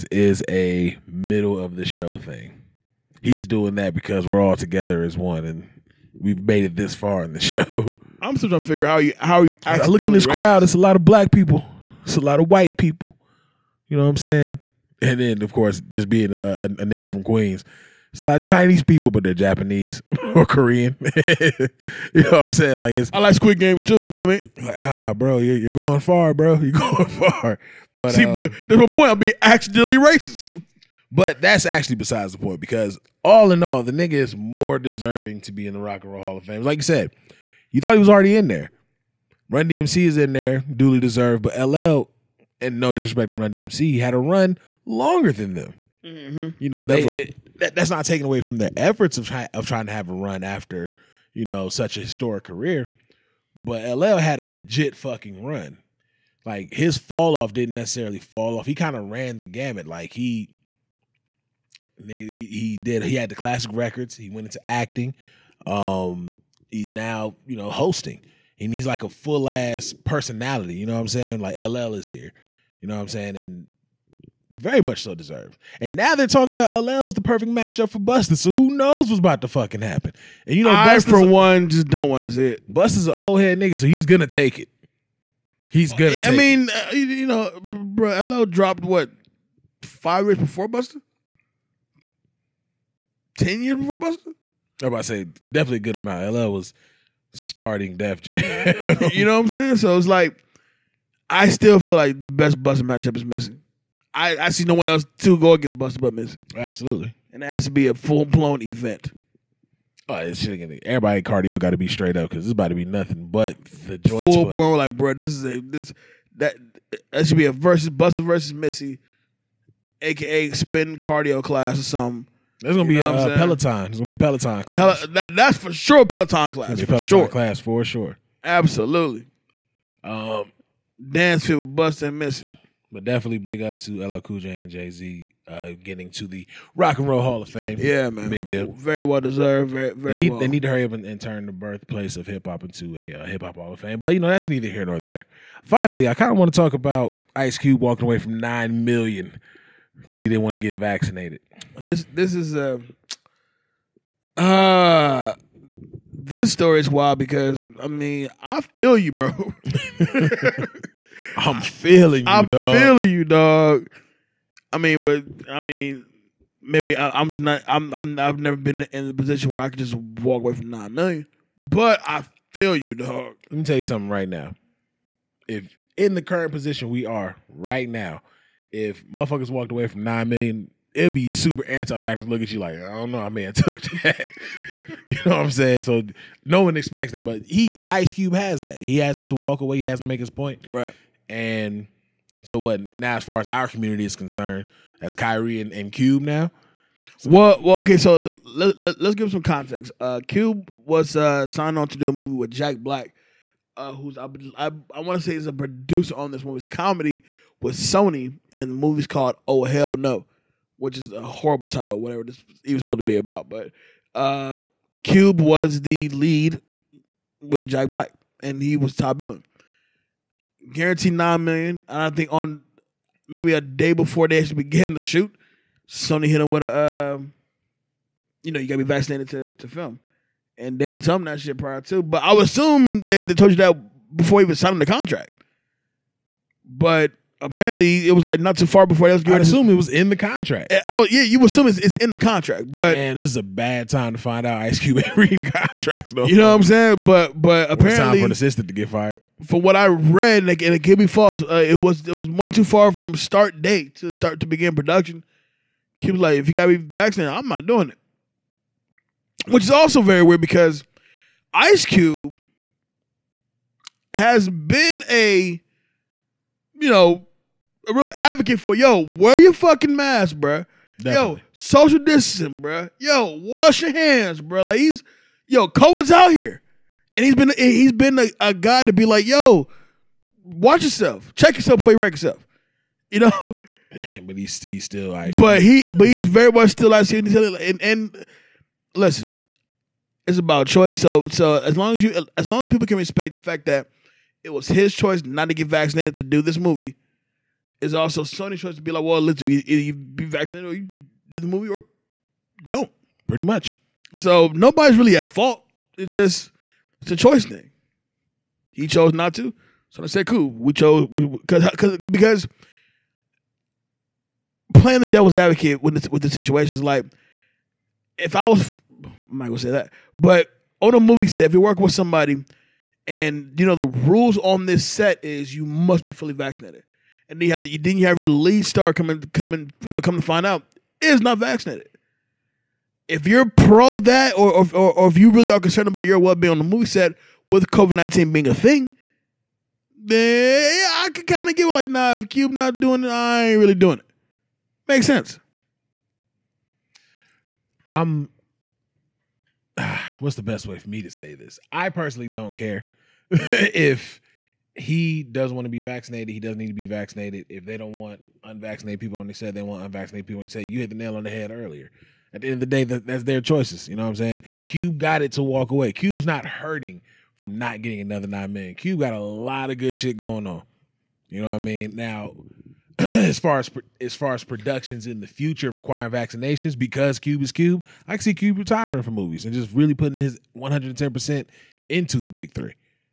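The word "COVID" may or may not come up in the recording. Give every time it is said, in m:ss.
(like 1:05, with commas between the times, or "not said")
4:35, 5:37.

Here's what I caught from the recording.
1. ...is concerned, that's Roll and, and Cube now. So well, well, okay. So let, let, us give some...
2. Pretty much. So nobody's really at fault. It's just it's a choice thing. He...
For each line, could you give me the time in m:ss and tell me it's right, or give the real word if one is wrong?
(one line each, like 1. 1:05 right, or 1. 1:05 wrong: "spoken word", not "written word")
1. 3:14 wrong: "Kyrie", not "Roll"
2. 5:03 right.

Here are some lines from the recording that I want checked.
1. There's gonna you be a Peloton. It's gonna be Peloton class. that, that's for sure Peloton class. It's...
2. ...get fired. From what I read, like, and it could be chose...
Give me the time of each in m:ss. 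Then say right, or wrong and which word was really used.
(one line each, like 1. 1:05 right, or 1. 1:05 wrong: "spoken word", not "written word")
1. 2:02 right
2. 4:08 wrong: "false", not "chose".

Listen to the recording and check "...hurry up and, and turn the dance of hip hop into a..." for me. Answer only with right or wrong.
wrong.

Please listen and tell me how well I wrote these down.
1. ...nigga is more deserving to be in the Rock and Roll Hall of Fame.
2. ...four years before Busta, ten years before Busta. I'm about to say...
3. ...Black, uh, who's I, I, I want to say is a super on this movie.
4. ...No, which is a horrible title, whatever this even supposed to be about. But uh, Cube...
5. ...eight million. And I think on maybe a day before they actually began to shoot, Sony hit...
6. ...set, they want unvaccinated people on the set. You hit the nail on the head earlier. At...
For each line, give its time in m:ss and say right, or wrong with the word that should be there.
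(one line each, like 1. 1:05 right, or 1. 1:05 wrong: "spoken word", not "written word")
1. 0:33 right
2. 1:29 wrong: "five", not "four"
3. 3:22 wrong: "producer", not "super"
4. 3:29 right
5. 3:41 wrong: "nine", not "eight"
6. 5:59 right.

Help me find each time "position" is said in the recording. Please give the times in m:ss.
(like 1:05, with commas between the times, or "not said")
2:49, 2:56.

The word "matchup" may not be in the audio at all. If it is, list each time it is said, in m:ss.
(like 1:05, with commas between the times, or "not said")
1:17, 1:42.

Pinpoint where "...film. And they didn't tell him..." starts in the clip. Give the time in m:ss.
3:49.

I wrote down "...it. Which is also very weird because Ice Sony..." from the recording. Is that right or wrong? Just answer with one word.
wrong.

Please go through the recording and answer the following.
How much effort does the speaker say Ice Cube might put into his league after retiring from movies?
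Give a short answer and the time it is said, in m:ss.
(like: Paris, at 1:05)
110 percent, at 6:20.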